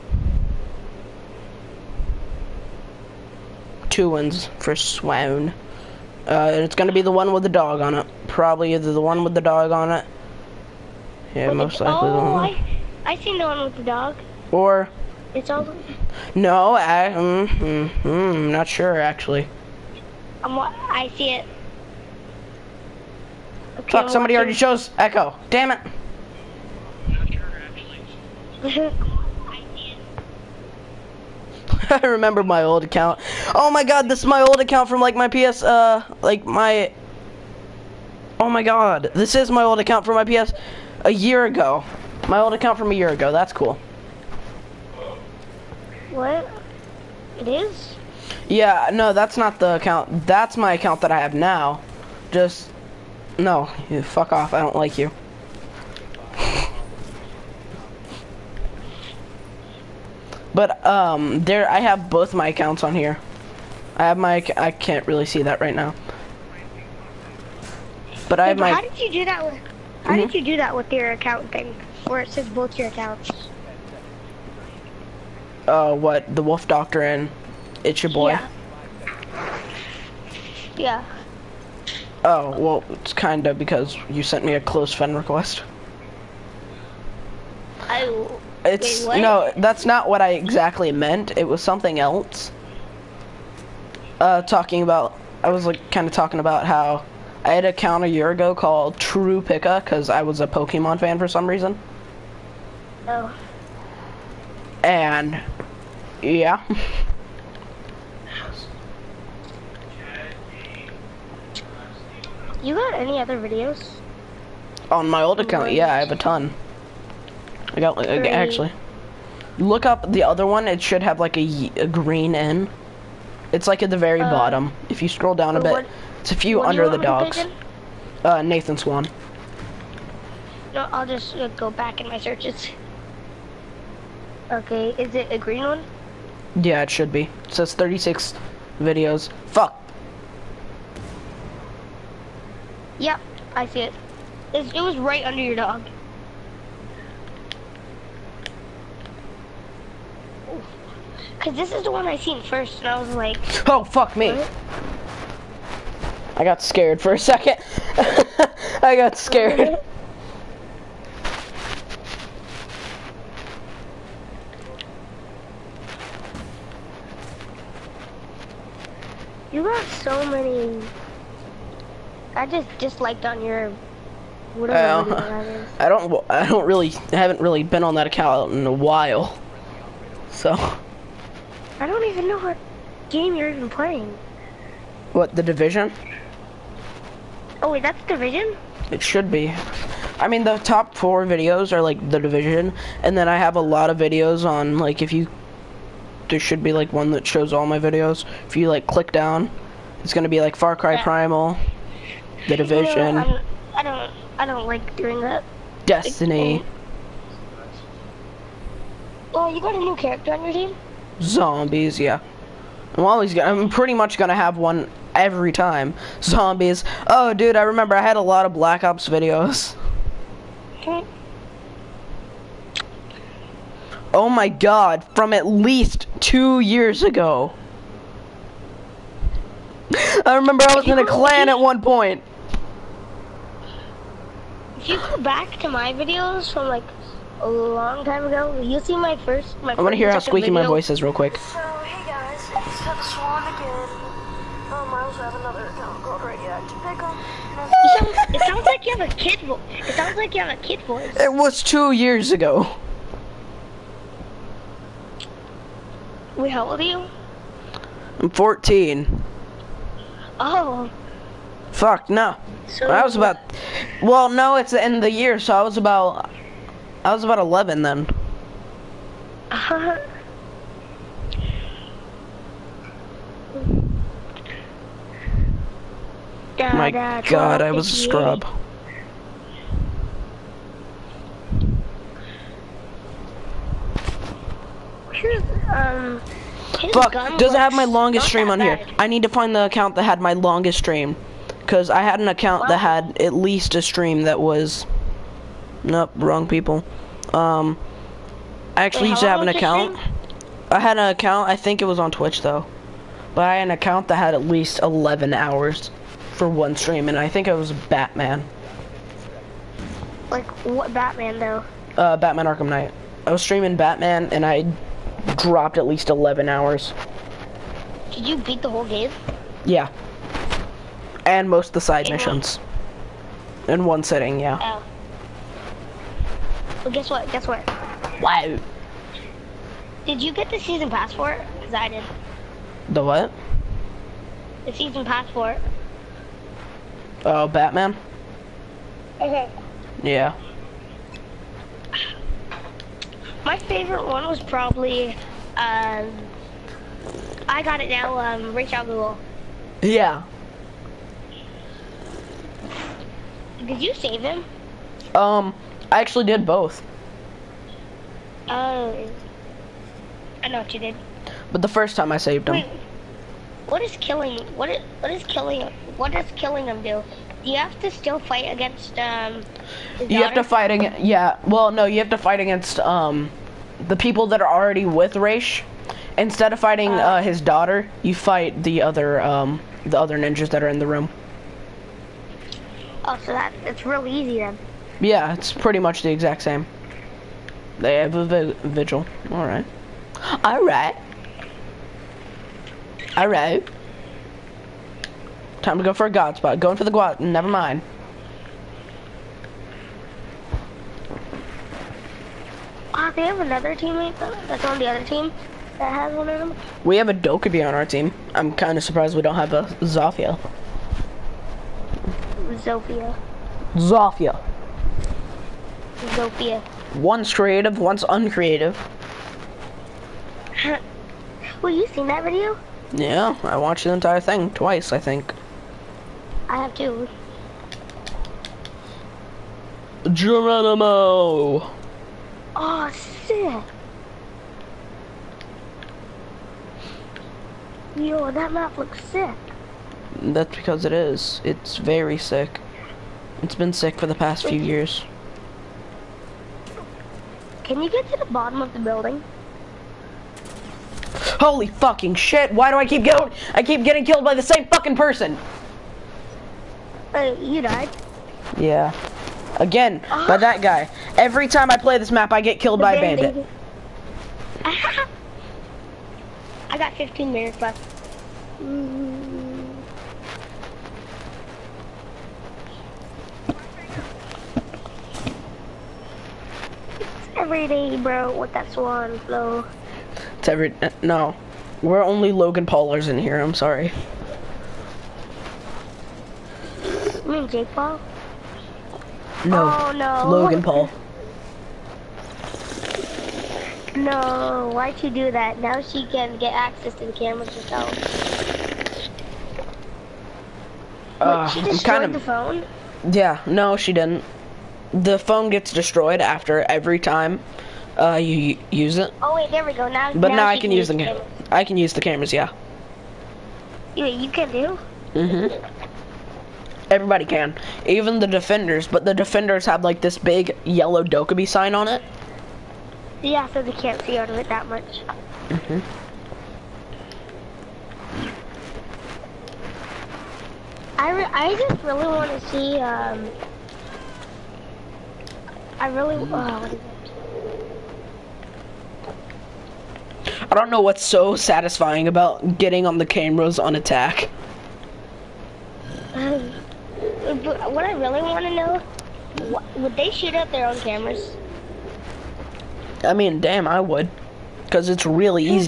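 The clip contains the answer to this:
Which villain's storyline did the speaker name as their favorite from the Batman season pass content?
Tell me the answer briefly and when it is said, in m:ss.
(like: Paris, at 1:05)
Ra's al Ghul, at 5:48.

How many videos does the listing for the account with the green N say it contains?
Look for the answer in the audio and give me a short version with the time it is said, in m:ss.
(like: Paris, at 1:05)
36, at 2:17.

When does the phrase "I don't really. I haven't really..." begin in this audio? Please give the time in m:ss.
2:56.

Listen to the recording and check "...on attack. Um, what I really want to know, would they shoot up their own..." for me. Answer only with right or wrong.
right.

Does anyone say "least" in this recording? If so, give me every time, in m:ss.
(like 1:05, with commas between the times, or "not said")
3:45, 4:53, 5:04, 5:15.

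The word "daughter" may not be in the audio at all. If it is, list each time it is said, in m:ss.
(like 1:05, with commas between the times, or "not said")
6:10, 6:17.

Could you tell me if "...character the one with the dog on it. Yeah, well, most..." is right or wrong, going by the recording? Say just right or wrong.
wrong.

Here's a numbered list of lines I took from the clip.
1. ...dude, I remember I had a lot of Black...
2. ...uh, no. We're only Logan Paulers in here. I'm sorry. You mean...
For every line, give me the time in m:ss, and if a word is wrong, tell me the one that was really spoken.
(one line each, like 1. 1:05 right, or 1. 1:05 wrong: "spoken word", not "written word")
1. 3:37 right
2. 8:00 right.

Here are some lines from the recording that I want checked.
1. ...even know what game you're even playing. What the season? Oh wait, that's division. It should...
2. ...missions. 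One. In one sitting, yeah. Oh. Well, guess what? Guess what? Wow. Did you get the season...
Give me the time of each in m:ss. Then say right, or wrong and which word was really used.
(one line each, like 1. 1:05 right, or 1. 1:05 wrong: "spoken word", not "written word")
1. 3:02 wrong: "division", not "season"
2. 5:22 right.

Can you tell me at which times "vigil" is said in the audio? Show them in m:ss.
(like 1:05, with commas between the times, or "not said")
6:28.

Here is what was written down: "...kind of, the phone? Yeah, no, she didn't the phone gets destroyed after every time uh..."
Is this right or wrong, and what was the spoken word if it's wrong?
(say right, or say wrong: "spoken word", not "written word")
right.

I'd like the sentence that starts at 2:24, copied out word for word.
It's, it was right under your dog.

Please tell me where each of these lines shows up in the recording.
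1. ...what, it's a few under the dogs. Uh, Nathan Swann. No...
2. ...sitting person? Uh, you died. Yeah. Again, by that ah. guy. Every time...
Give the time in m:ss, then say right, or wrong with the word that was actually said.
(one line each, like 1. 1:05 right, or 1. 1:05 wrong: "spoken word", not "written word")
1. 2:05 right
2. 7:34 wrong: "fucking", not "sitting".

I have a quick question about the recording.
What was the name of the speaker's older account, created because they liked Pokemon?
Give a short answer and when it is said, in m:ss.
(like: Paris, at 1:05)
True Picka, at 1:38.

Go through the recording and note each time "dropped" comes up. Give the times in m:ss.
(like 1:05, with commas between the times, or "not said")
5:15.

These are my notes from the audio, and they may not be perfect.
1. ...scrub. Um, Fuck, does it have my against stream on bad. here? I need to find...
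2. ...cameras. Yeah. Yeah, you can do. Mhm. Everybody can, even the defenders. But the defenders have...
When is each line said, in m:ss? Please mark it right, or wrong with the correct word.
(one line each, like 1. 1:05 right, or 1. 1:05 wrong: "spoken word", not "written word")
1. 4:37 wrong: "longest", not "against"
2. 8:32 right.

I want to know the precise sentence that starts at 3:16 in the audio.
There should be like one that shows all my videos.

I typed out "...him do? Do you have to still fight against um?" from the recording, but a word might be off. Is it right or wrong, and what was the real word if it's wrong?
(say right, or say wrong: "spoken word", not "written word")
right.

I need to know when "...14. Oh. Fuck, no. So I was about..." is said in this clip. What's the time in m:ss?
4:18.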